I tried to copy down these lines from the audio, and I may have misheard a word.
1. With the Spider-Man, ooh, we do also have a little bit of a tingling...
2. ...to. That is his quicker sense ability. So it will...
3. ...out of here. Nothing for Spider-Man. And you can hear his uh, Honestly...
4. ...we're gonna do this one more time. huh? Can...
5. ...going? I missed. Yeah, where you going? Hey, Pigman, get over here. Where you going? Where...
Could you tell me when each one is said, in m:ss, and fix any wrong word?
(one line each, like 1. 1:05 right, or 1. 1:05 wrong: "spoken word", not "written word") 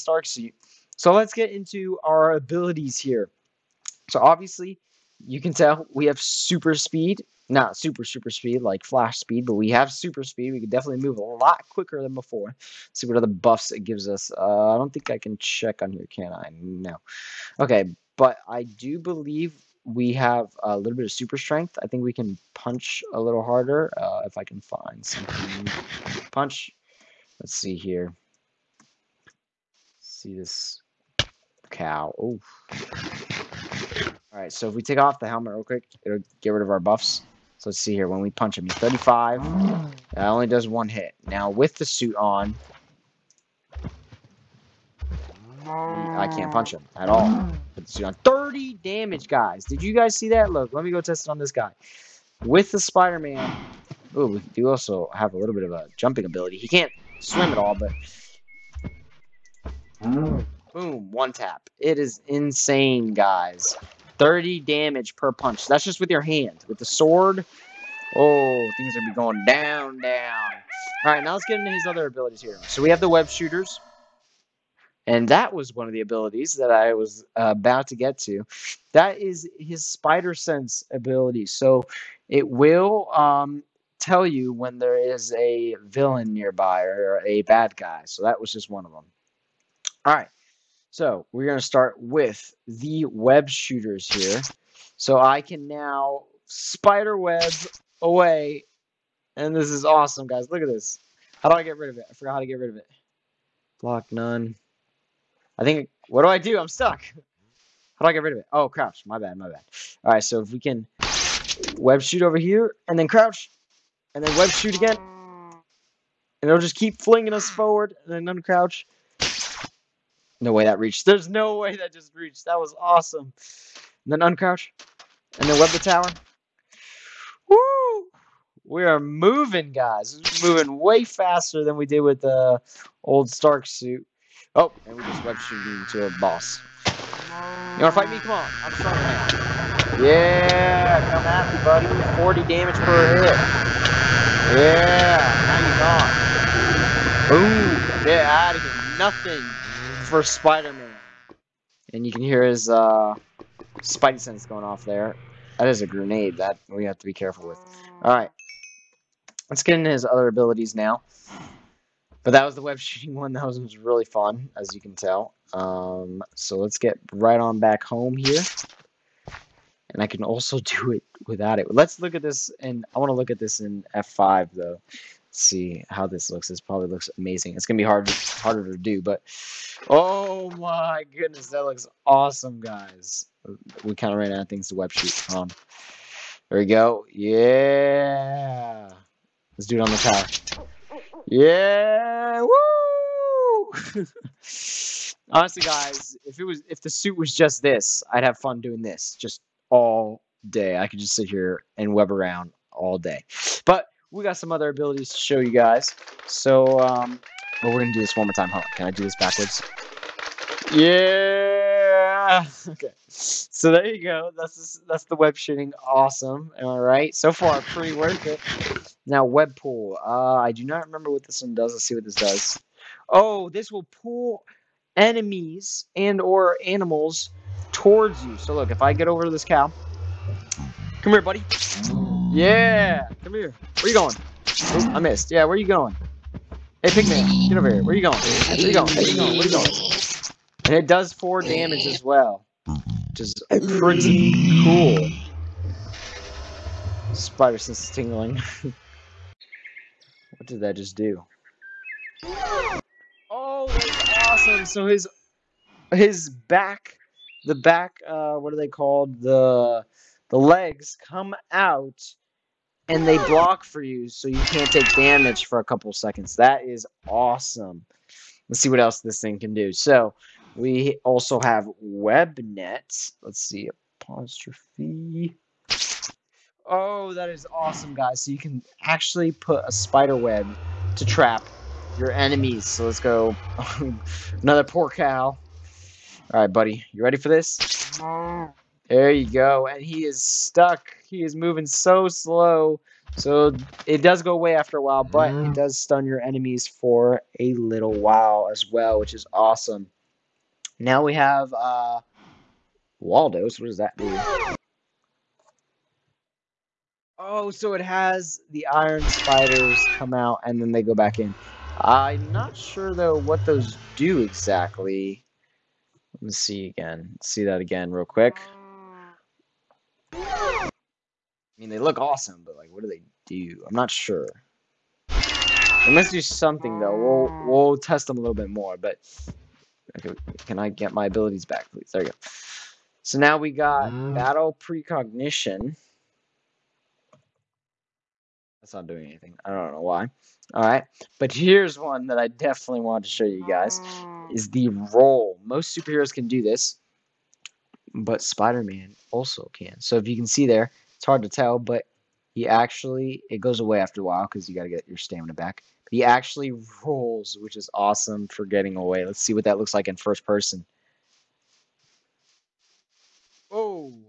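1. 0:52 wrong: "jumping", not "tingling"
2. 1:18 wrong: "spider", not "quicker"
3. 2:28 wrong: "Spidey", not "Honestly"
4. 3:27 right
5. 3:53 right.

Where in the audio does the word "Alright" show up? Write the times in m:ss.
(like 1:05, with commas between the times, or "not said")
2:38.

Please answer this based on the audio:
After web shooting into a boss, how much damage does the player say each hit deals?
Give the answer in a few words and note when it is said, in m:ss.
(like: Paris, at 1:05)
40, at 2:22.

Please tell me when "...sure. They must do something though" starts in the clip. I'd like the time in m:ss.
5:23.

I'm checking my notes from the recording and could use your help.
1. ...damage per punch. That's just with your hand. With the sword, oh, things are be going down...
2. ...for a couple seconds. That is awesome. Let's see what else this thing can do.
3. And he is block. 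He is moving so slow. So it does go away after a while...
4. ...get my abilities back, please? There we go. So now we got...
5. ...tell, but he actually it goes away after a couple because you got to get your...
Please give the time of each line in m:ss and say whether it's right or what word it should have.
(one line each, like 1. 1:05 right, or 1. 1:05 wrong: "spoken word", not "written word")
1. 1:04 right
2. 4:25 right
3. 4:49 wrong: "stuck", not "block"
4. 5:30 right
5. 5:51 wrong: "while", not "couple".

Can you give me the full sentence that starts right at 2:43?
That was, really fun, as you can tell.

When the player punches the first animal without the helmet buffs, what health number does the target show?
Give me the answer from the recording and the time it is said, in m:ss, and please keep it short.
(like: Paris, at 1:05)
35, at 0:38.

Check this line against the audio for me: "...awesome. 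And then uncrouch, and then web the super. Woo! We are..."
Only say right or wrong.
wrong.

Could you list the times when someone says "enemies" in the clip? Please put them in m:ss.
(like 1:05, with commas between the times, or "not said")
3:44, 4:42, 4:56.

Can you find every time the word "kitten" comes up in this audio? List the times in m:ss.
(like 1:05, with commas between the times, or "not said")
not said.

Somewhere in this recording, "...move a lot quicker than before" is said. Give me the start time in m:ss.
0:11.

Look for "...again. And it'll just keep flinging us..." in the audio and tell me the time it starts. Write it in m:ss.
1:54.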